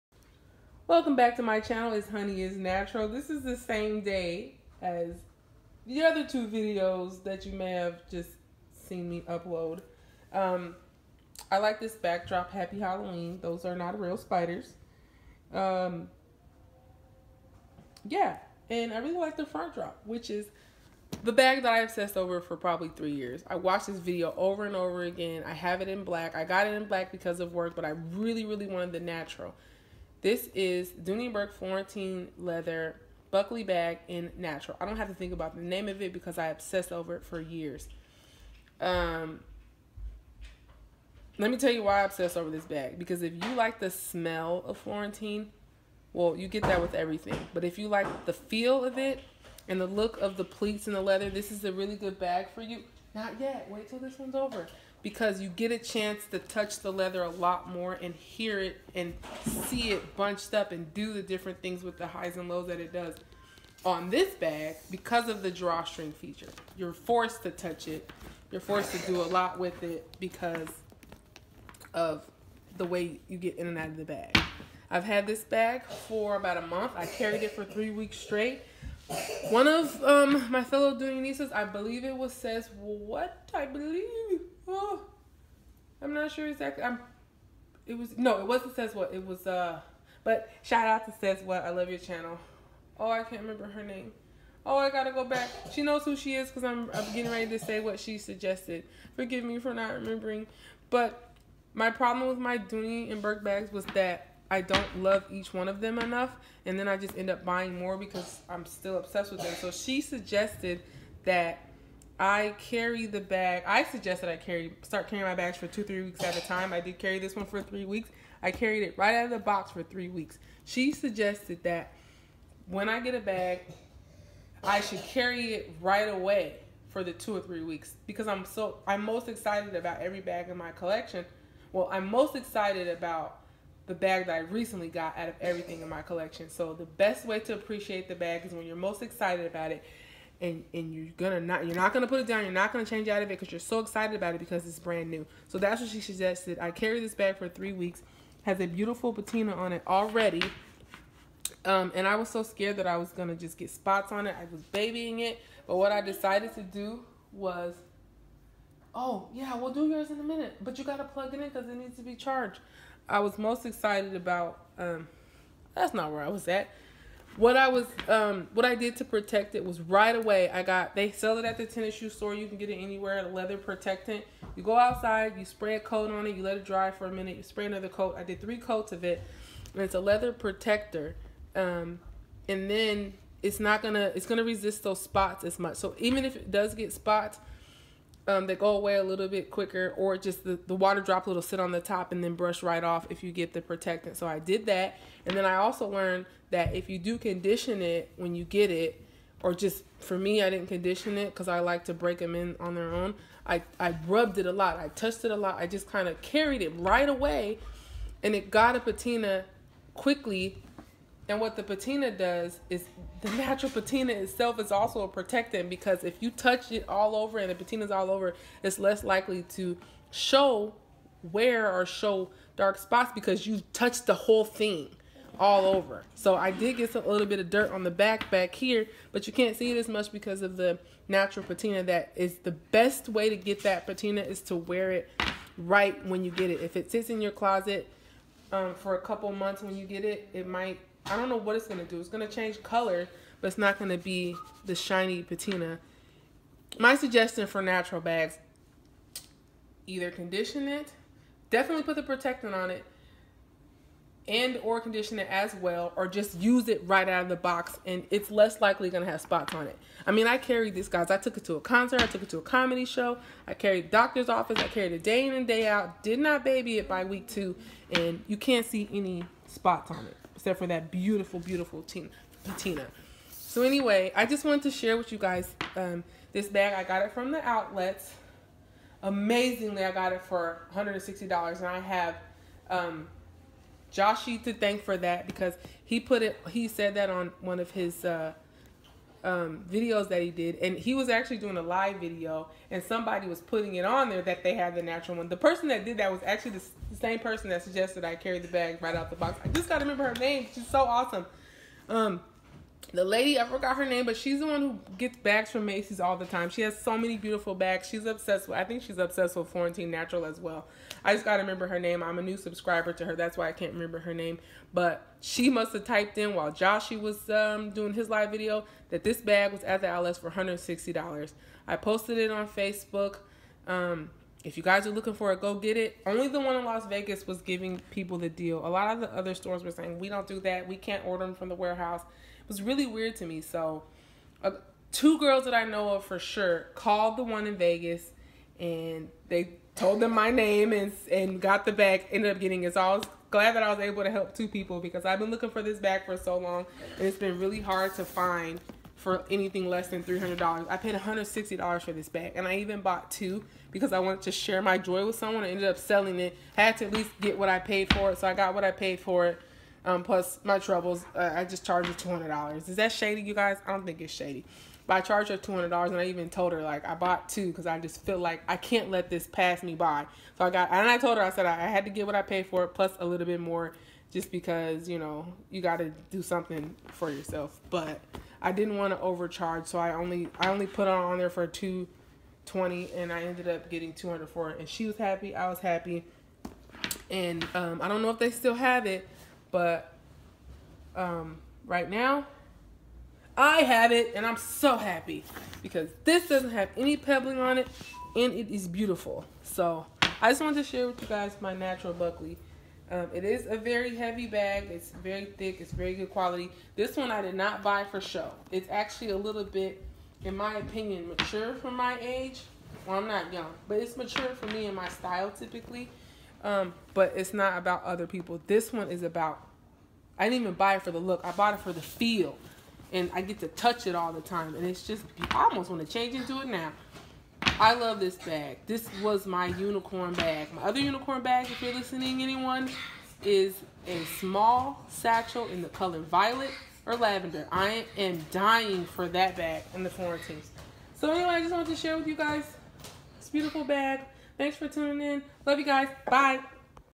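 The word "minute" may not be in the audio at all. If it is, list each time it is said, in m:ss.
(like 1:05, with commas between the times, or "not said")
2:40, 2:57.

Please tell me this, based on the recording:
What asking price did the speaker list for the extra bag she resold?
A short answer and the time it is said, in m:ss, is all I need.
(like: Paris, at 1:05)
$220, at 6:21.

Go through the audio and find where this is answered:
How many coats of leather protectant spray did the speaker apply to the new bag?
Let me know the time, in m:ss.
2:58.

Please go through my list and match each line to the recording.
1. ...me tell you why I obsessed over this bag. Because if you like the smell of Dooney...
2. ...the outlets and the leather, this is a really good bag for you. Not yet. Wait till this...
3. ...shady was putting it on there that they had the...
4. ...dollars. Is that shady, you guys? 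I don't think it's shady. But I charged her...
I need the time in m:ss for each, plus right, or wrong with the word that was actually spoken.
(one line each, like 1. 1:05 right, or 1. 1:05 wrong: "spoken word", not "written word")
1. 0:41 wrong: "Florentine", not "Dooney"
2. 0:50 wrong: "pleats", not "outlets"
3. 4:52 wrong: "somebody", not "shady"
4. 6:02 right.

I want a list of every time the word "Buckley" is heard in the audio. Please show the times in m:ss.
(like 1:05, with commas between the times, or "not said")
0:33, 6:41.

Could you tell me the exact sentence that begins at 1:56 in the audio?
I did carry this one for three weeks.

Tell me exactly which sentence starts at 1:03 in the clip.
On this bag, because of the drawstring feature, you're forced to touch it.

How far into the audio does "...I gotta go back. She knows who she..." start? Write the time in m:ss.
1:34.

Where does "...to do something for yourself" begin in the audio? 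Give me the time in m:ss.
6:15.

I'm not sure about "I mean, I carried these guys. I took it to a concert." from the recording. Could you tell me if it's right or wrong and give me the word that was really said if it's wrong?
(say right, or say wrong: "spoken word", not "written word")
right.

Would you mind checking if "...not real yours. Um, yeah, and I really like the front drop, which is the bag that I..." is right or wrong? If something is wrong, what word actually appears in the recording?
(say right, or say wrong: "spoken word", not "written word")
wrong: "spiders", not "yours".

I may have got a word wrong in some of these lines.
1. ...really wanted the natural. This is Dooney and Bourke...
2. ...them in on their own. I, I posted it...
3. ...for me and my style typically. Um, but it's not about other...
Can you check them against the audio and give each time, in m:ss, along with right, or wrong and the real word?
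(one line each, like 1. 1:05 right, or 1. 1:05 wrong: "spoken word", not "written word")
1. 0:28 right
2. 3:22 wrong: "rubbed", not "posted"
3. 6:54 right.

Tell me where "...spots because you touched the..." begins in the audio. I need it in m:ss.
3:42.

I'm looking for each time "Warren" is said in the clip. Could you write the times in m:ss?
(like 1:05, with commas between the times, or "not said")
not said.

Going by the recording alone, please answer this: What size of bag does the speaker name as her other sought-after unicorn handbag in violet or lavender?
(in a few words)
small satchel.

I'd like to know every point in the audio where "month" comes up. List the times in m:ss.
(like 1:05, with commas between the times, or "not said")
1:16, 3:59.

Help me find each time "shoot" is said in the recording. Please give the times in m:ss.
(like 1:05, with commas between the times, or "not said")
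not said.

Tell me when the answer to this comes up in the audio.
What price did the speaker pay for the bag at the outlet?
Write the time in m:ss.
4:39.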